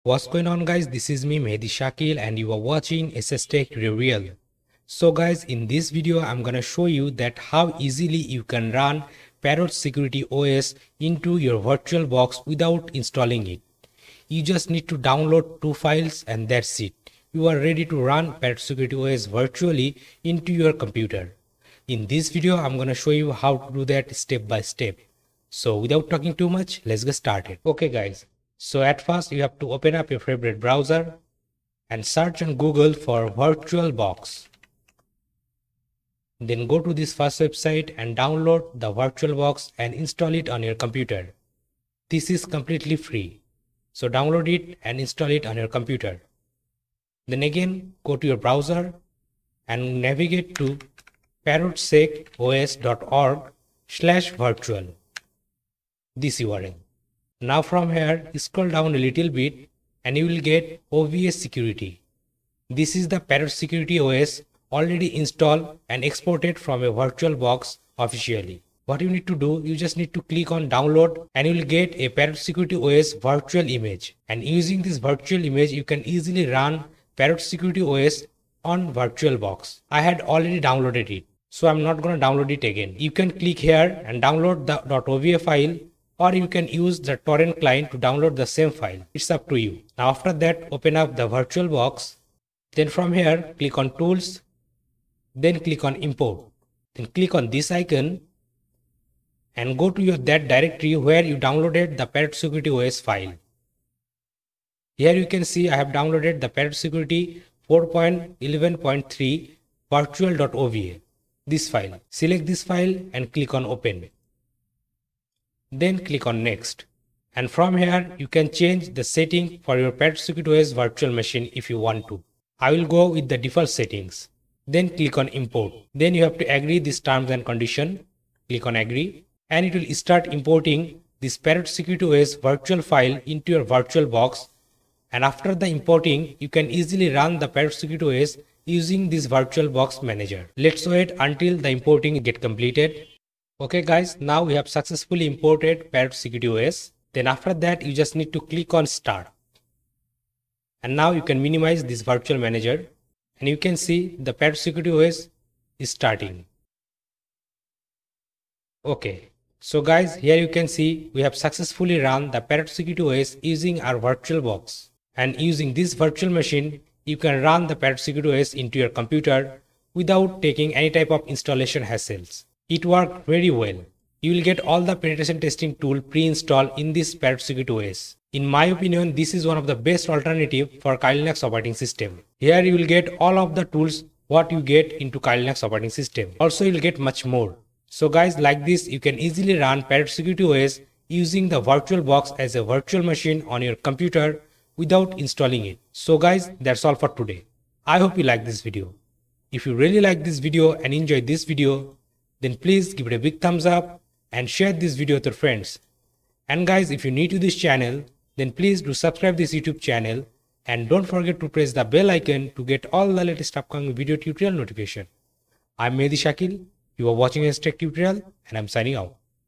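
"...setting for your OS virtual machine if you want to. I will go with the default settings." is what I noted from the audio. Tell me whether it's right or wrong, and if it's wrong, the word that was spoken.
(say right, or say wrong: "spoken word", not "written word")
right.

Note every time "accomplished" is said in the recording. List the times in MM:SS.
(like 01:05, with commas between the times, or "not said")
not said.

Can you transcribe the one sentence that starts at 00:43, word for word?
So download it and install it on your computer.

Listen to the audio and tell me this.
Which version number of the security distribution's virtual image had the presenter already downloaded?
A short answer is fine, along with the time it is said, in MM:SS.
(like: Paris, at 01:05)
4.11.3, at 01:47.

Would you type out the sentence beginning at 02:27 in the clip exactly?
Then after that, you just need to click on start.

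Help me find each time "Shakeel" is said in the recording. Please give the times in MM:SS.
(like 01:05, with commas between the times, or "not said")
00:01, 03:36.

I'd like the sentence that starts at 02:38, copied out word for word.
Okay, so guys, here you can see we have successfully run the Parrot Security OS using our virtual box.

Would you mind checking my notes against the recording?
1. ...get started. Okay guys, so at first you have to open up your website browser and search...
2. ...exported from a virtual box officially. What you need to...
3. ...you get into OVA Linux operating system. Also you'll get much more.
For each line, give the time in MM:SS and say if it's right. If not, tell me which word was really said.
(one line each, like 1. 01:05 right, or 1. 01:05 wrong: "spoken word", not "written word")
1. 00:27 wrong: "favorite", not "website"
2. 01:06 right
3. 03:04 wrong: "Kali", not "OVA".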